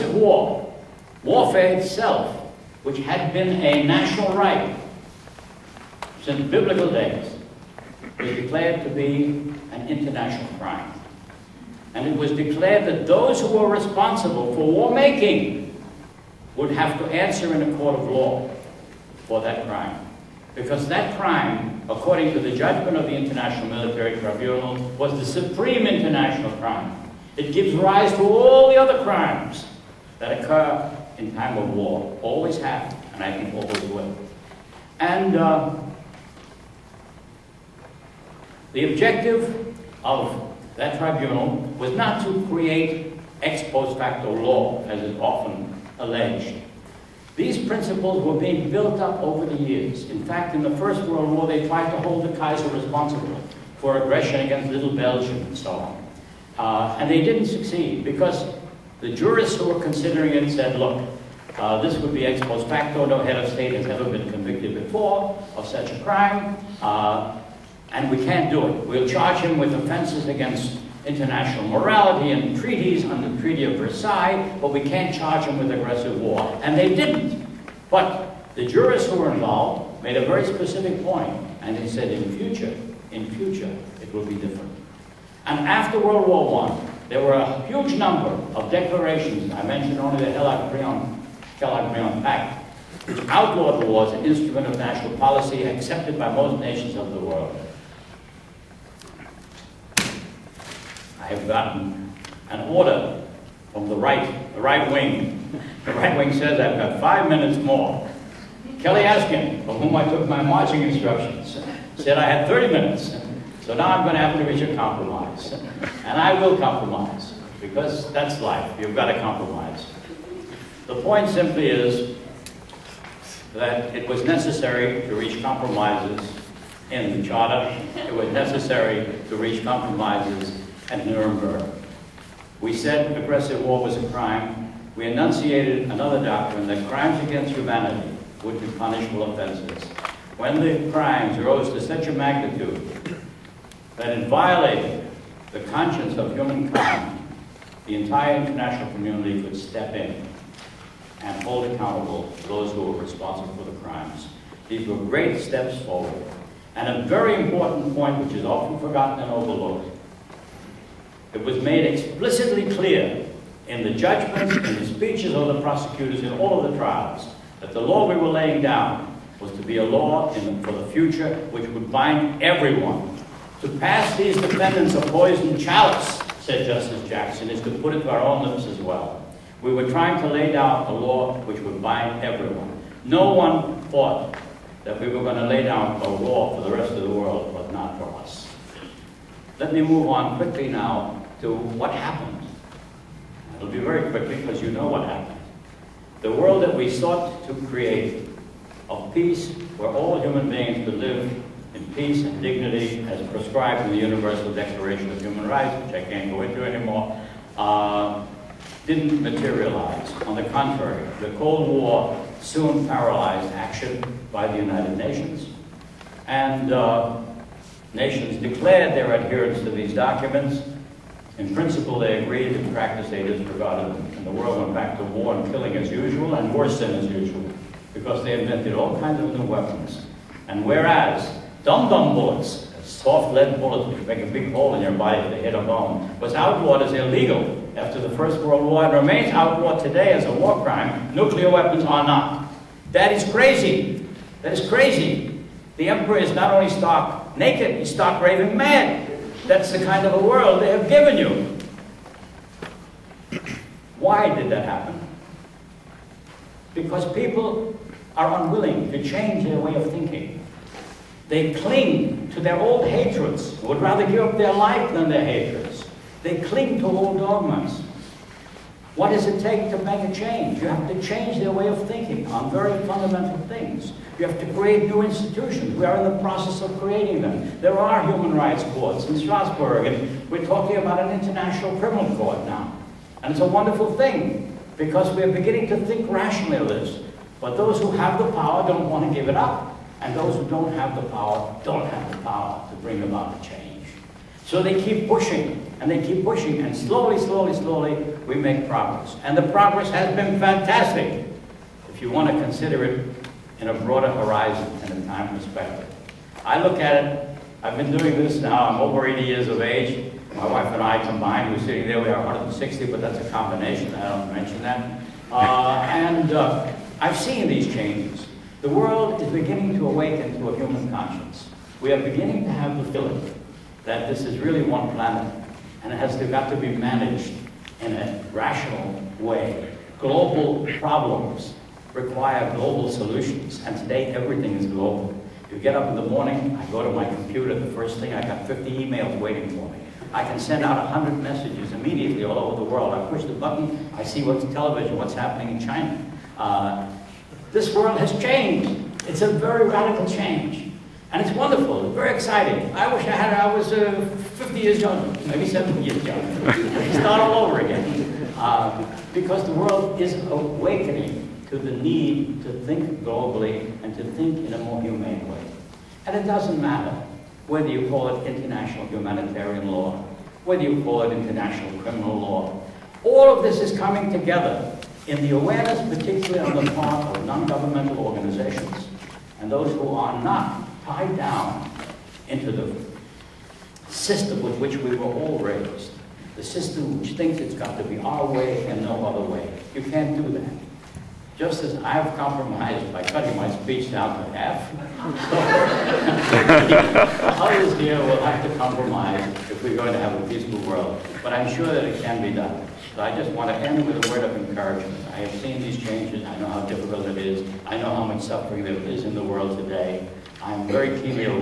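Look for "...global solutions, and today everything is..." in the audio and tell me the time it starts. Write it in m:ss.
5:32.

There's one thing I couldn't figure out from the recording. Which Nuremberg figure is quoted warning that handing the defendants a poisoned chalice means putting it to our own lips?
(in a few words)
Justice Jackson.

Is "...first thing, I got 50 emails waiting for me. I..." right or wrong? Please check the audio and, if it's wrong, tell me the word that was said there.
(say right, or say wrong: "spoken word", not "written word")
right.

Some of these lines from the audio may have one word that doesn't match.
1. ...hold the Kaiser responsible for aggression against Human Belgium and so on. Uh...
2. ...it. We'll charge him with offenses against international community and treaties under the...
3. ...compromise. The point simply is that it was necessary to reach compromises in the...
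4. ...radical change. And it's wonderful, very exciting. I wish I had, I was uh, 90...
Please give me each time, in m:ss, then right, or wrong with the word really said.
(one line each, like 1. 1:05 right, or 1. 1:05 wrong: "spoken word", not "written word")
1. 0:52 wrong: "Little", not "Human"
2. 1:08 wrong: "morality", not "community"
3. 1:59 right
4. 5:49 wrong: "50", not "90".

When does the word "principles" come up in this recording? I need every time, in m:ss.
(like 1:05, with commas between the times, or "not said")
0:47, 3:41.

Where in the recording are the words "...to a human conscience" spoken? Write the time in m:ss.
5:20.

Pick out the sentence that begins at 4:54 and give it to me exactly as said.
So they keep pushing and they keep pushing, and slowly, slowly, slowly, we make progress.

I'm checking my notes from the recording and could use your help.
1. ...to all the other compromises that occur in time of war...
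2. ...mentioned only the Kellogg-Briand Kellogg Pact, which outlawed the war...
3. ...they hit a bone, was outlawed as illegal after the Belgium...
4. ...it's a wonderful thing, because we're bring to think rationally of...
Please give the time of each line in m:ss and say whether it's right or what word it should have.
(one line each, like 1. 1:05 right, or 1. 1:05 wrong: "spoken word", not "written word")
1. 0:28 wrong: "crimes", not "compromises"
2. 1:29 right
3. 3:55 wrong: "First", not "Belgium"
4. 4:43 wrong: "beginning", not "bring".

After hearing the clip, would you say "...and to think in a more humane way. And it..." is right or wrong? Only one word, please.
right.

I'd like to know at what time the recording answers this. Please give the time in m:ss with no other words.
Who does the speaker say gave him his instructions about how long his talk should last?
1:48.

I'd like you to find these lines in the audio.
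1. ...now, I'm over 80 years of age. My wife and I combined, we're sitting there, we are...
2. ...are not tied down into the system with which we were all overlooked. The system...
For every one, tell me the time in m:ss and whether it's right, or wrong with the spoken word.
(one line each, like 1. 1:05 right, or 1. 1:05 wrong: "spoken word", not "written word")
1. 5:08 right
2. 6:19 wrong: "raised", not "overlooked".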